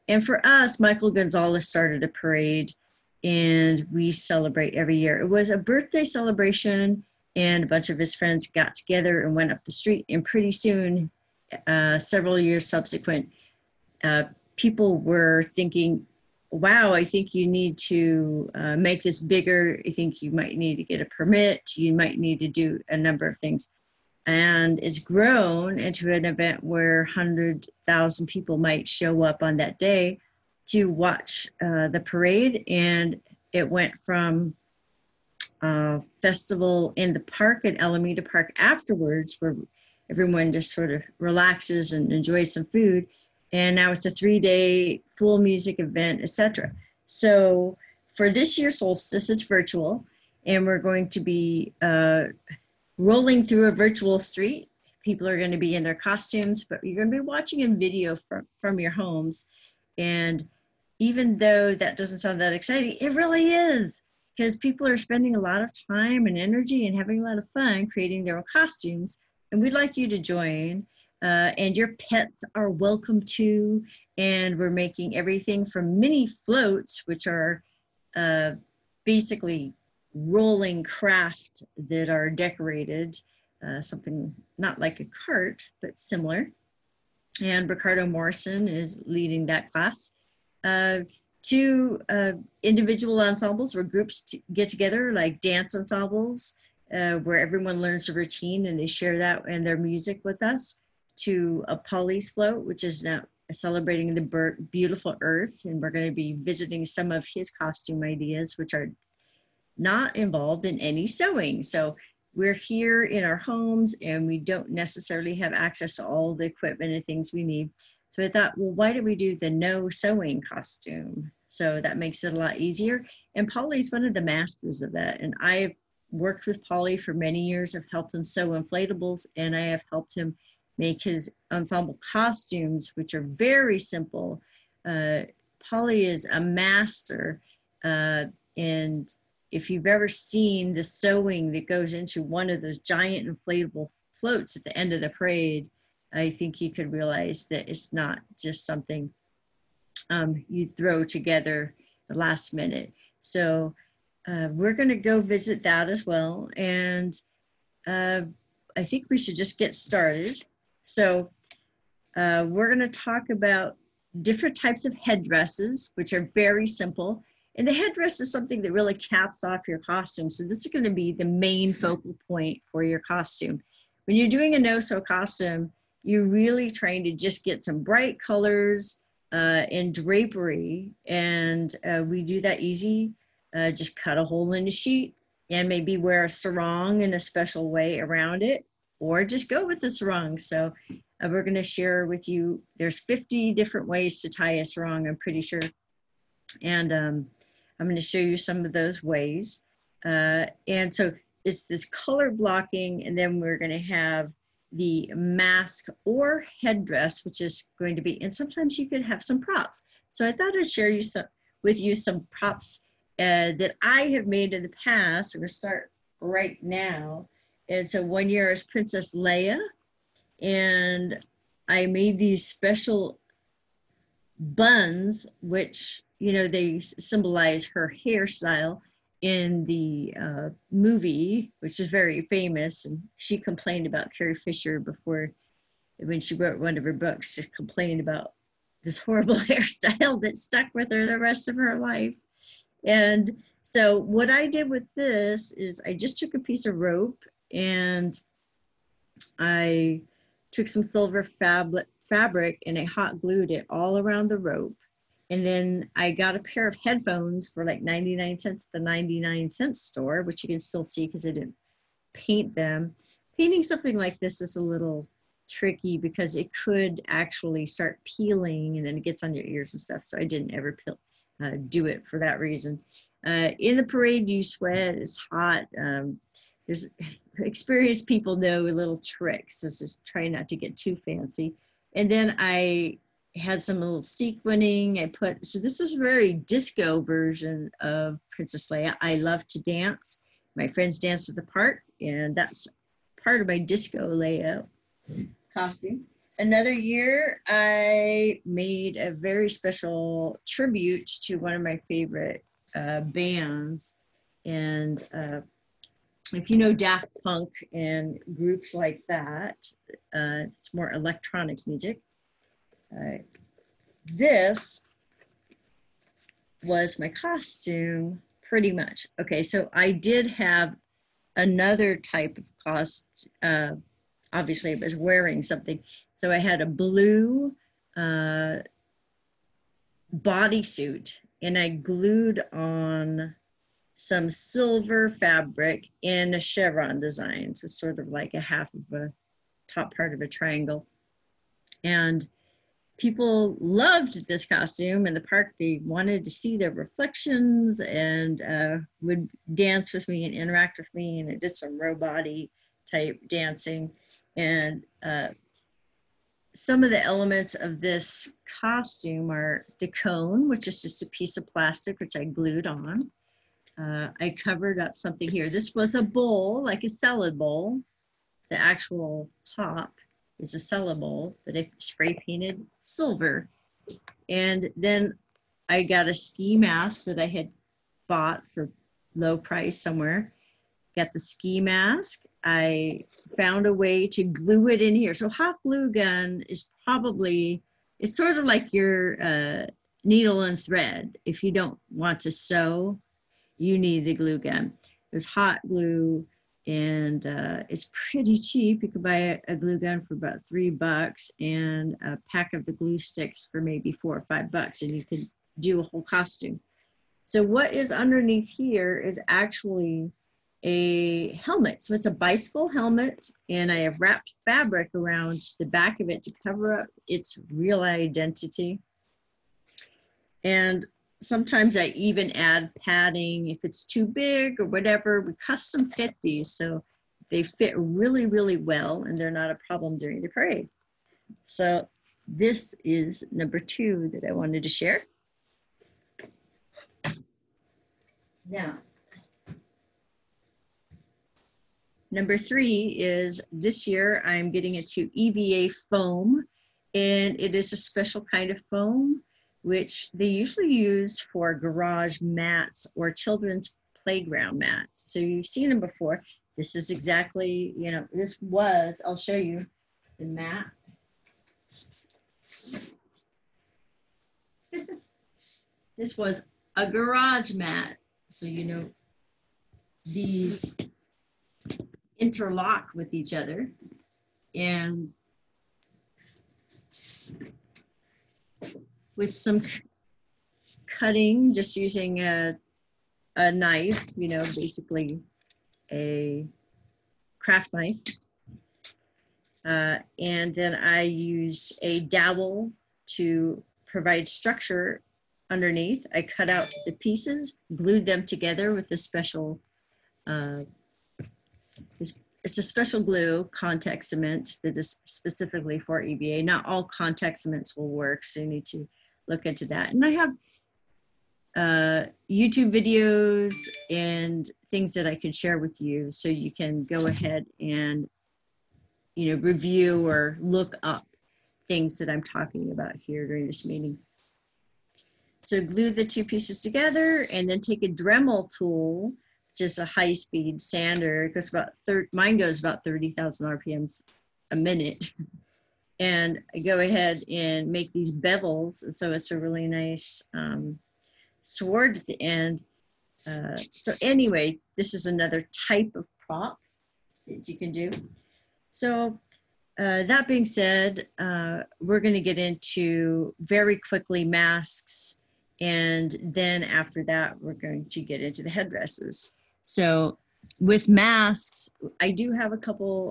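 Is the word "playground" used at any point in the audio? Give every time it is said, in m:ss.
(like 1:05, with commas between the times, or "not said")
7:34.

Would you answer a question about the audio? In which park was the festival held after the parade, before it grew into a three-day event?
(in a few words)
Alameda Park.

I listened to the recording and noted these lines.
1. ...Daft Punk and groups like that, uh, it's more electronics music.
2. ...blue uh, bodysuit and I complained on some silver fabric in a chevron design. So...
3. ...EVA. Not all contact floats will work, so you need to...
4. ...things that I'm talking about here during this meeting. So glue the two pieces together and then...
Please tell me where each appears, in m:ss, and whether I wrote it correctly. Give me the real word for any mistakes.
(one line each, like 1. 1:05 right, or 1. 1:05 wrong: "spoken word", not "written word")
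1. 5:06 right
2. 5:26 wrong: "glued", not "complained"
3. 8:26 wrong: "cements", not "floats"
4. 8:41 right.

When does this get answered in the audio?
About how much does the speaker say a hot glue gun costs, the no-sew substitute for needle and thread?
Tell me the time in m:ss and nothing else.
6:40.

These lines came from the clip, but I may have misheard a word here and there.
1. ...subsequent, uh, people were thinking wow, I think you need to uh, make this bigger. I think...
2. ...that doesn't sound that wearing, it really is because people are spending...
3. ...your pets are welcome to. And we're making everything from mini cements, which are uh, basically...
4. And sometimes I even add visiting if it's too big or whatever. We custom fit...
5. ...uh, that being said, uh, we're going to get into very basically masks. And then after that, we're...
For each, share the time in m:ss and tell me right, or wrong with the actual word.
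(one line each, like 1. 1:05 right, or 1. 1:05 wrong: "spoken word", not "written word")
1. 0:12 right
2. 1:01 wrong: "exciting", not "wearing"
3. 1:11 wrong: "floats", not "cements"
4. 7:00 wrong: "padding", not "visiting"
5. 9:09 wrong: "quickly", not "basically".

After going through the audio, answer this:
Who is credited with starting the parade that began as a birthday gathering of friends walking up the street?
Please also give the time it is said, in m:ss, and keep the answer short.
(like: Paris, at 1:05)
Michael Gonzales, at 0:00.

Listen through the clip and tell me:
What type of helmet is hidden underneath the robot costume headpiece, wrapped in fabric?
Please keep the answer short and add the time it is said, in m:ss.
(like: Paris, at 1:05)
Bicycle helmet, at 6:52.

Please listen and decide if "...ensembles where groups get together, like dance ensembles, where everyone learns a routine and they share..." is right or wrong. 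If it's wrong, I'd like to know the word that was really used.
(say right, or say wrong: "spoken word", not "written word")
right.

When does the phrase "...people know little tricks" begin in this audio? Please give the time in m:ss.
4:38.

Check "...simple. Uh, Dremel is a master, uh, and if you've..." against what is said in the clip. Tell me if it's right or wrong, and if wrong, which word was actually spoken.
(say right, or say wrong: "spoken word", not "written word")
wrong: "Polly", not "Dremel".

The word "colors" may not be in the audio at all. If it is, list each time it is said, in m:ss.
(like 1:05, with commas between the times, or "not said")
2:58, 3:21.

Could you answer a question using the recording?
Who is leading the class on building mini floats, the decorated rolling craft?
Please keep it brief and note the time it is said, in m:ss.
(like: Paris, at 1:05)
Ricardo Morrison, at 1:27.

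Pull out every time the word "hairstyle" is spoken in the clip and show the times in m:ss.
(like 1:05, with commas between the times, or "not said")
3:48, 3:59.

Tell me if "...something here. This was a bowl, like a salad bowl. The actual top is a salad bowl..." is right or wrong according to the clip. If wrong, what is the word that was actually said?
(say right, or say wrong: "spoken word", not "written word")
right.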